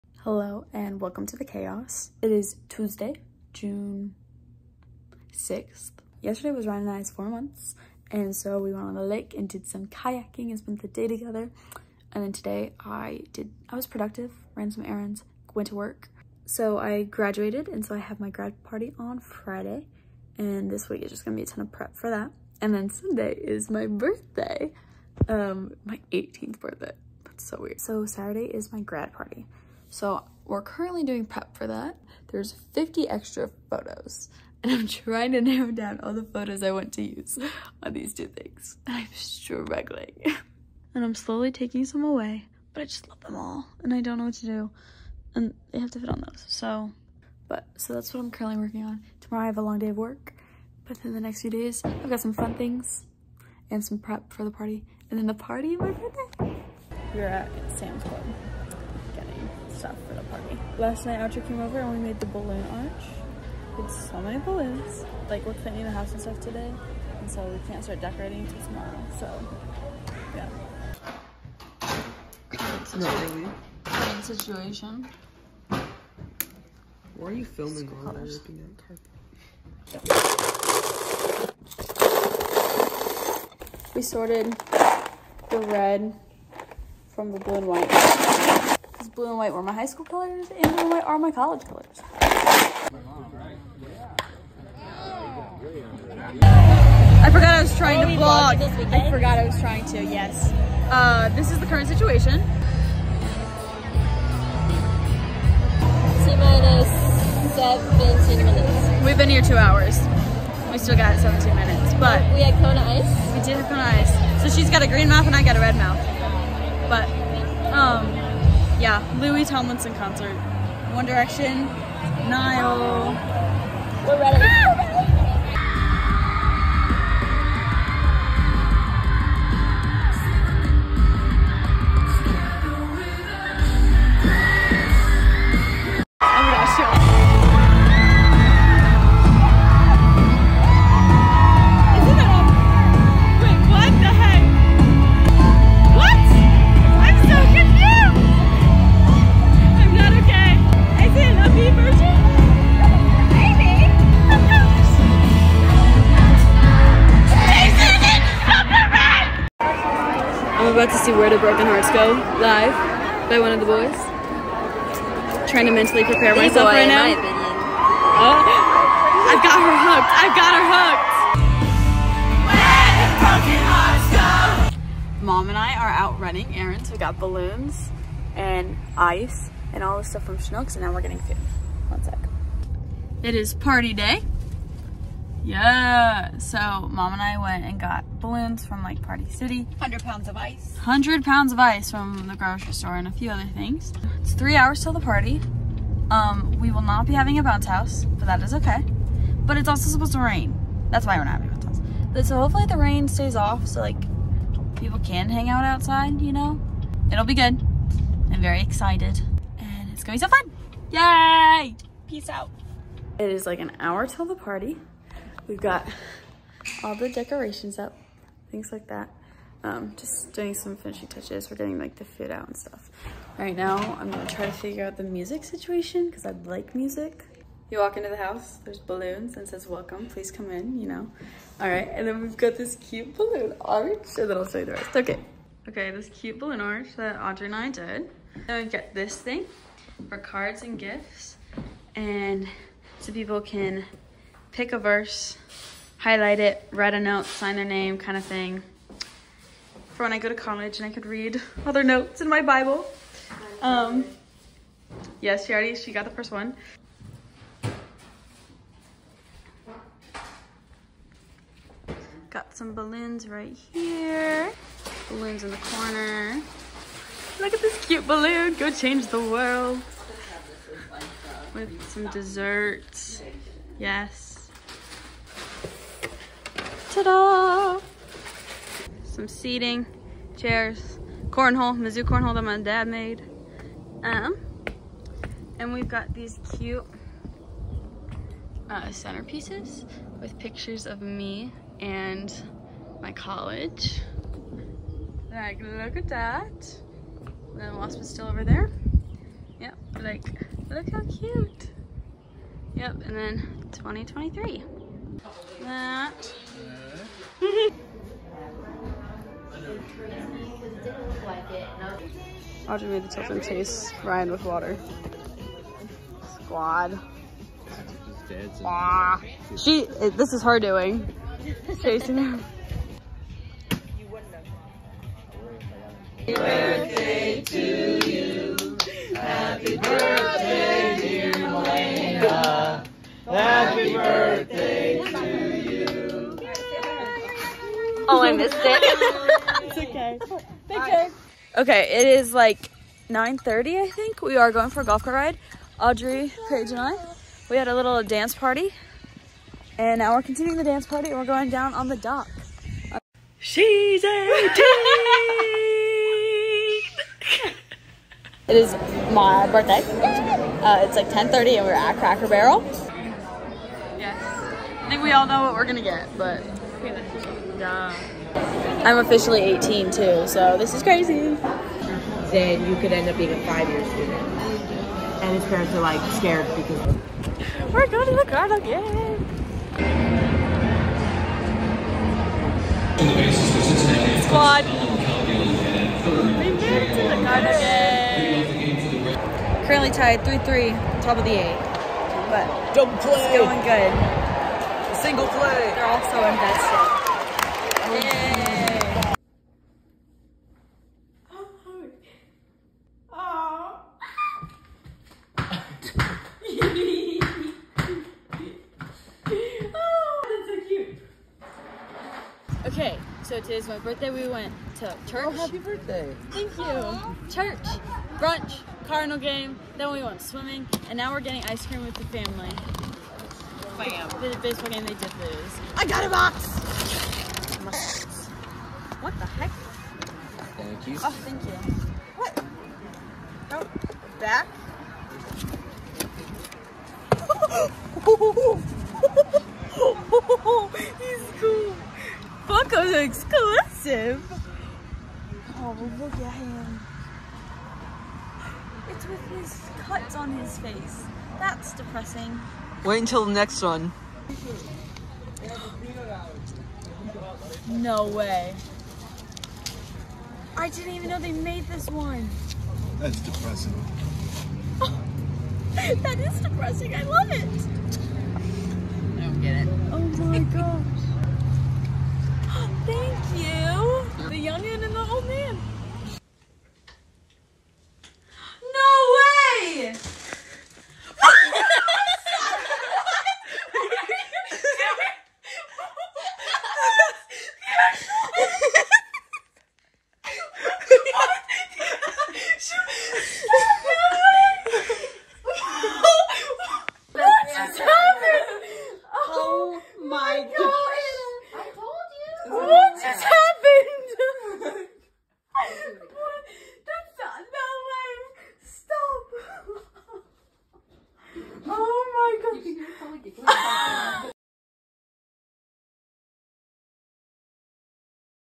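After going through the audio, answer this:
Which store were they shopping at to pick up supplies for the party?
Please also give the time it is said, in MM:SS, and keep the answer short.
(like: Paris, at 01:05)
Sam's Club, at 00:57.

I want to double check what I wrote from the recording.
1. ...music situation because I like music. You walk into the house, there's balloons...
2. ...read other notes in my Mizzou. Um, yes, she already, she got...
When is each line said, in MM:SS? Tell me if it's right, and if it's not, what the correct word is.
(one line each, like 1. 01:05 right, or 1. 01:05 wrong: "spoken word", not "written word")
1. 03:45 right
2. 04:11 wrong: "Bible", not "Mizzou".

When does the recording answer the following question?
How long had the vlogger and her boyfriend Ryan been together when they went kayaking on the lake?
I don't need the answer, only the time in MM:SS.
00:07.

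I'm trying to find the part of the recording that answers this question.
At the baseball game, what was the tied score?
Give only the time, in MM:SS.
06:30.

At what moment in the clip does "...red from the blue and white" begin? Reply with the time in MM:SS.
01:25.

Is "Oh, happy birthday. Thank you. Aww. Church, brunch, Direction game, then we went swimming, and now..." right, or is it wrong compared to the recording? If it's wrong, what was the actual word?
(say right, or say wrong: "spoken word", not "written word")
wrong: "Cardinal", not "Direction".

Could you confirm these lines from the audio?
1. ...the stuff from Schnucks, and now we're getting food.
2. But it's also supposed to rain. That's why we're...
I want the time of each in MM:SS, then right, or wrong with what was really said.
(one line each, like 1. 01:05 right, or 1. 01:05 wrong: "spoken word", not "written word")
1. 02:59 right
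2. 03:19 right.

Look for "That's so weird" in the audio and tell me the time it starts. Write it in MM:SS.
00:27.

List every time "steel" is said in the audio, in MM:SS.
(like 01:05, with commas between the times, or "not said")
not said.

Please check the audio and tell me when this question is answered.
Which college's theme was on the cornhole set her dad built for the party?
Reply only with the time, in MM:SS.
04:41.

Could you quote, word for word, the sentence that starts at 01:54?
So she's got a green mouth and I got a red mouth.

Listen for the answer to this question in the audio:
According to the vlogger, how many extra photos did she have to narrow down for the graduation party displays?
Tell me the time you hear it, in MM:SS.
00:32.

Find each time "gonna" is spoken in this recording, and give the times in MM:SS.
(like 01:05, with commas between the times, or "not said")
00:21, 03:30, 03:44, 06:05.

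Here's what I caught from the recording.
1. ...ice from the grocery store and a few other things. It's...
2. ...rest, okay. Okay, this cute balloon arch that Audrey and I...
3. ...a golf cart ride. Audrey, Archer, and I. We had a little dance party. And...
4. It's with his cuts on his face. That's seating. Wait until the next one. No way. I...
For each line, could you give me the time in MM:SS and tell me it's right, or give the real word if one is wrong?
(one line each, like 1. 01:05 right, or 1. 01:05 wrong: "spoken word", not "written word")
1. 03:11 right
2. 03:54 right
3. 05:44 wrong: "Paige", not "Archer"
4. 07:28 wrong: "depressing", not "seating".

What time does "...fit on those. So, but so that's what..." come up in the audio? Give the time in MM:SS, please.
00:45.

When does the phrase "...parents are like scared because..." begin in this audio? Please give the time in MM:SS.
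06:15.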